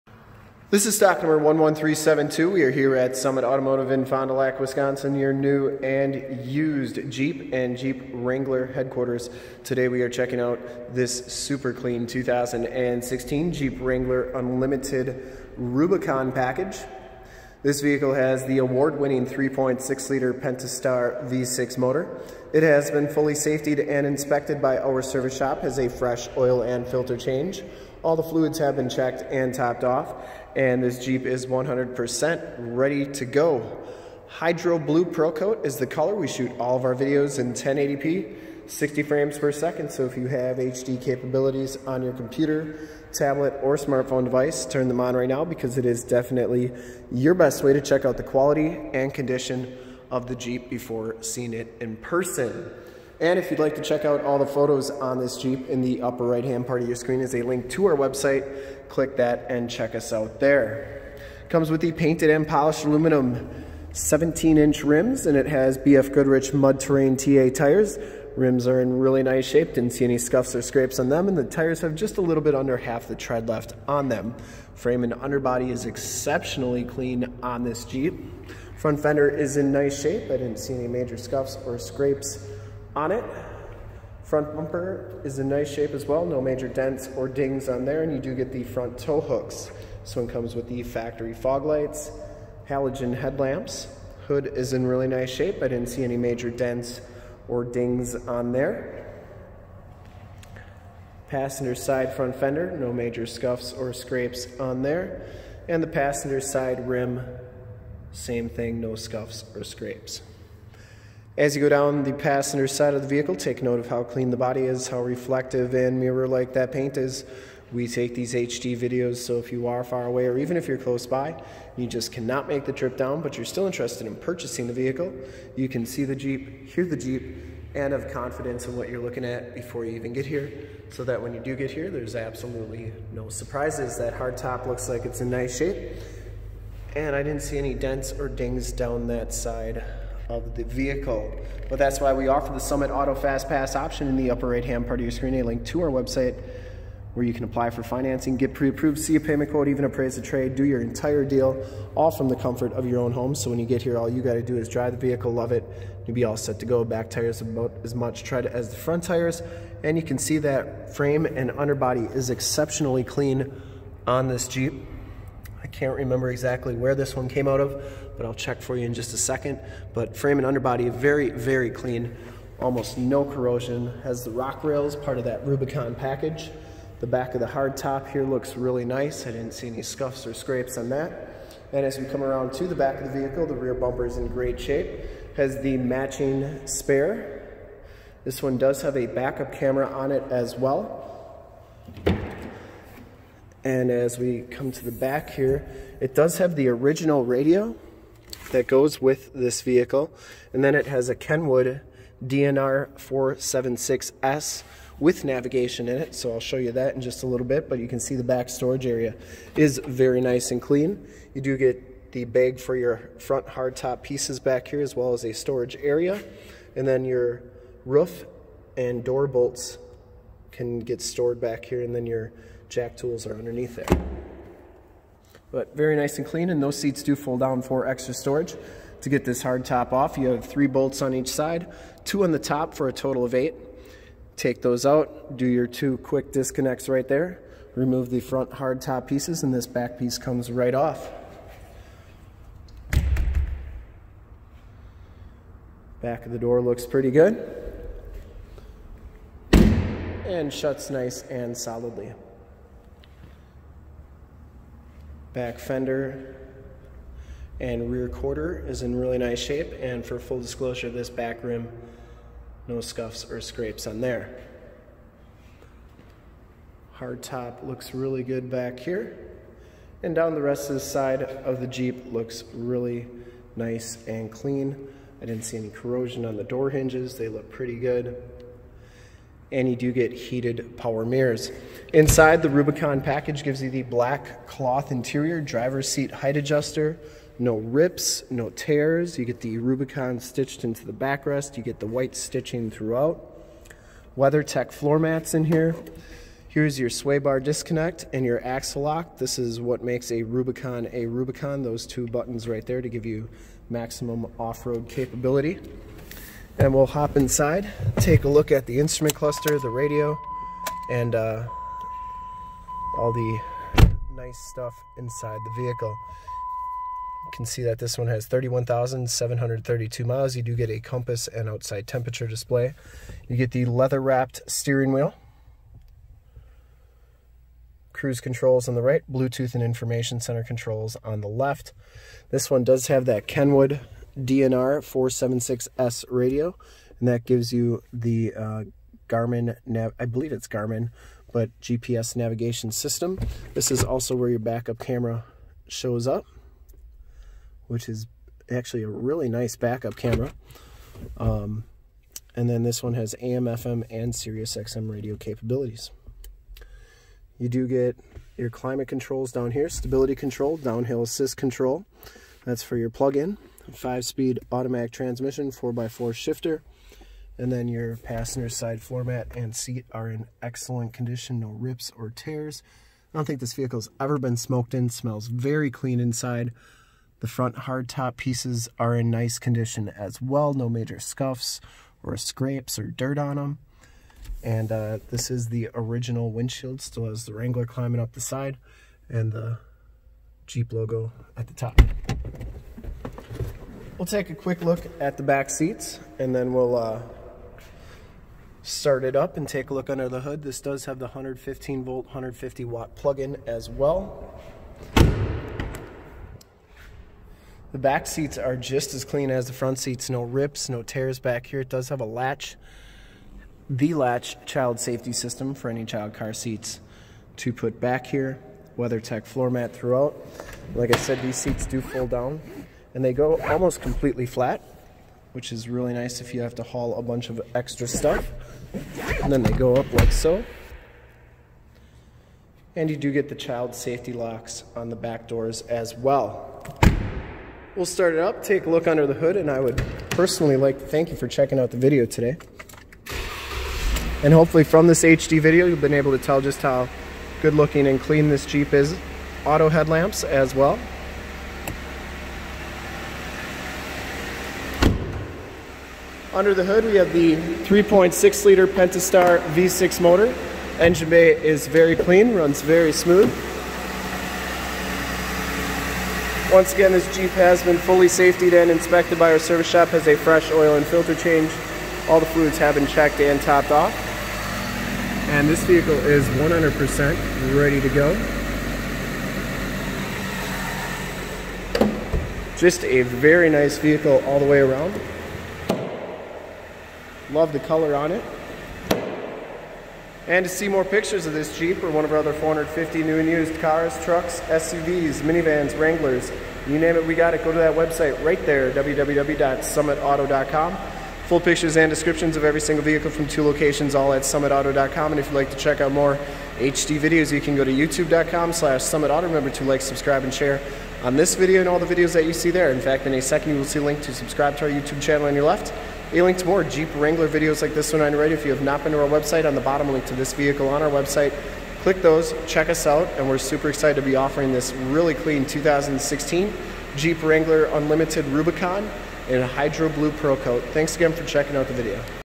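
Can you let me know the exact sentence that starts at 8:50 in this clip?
Thanks again for checking out the video.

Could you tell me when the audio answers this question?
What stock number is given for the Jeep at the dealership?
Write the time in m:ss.
0:00.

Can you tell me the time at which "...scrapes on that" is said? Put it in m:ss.
3:00.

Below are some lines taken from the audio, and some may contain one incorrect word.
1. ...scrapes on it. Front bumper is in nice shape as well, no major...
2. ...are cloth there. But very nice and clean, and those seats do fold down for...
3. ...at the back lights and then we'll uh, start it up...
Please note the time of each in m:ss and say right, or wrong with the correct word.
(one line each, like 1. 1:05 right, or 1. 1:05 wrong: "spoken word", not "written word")
1. 1:21 right
2. 3:43 wrong: "underneath", not "cloth"
3. 6:34 wrong: "seats", not "lights".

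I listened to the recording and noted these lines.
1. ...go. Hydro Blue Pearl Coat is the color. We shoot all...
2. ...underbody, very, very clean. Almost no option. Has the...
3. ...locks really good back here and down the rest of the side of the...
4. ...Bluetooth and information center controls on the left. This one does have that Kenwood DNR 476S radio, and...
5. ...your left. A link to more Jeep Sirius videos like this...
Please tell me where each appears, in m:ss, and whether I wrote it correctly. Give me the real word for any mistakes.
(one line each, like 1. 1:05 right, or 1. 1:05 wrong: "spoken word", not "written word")
1. 0:33 right
2. 2:50 wrong: "corrosion", not "option"
3. 4:27 wrong: "looks", not "locks"
4. 5:29 right
5. 8:35 wrong: "Wrangler", not "Sirius".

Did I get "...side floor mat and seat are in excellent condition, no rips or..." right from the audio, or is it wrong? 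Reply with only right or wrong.
right.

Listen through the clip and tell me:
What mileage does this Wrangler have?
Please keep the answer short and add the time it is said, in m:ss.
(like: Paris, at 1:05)
31,732, at 5:18.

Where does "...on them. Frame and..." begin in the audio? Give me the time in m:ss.
1:13.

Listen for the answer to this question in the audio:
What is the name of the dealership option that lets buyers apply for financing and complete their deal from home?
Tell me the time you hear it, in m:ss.
2:22.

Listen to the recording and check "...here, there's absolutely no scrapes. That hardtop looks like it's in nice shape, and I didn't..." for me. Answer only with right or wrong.
wrong.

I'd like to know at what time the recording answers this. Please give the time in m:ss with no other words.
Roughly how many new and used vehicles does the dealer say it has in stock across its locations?
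8:12.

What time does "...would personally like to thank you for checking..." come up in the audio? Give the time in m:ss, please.
7:19.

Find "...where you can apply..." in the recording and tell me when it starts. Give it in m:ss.
2:27.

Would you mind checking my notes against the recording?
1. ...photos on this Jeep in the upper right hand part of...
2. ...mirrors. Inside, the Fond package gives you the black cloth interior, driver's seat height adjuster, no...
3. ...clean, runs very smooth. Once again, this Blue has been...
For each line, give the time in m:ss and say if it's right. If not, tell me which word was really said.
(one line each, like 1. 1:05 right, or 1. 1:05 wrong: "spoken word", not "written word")
1. 0:54 right
2. 4:41 wrong: "Rubicon", not "Fond"
3. 7:41 wrong: "Jeep", not "Blue".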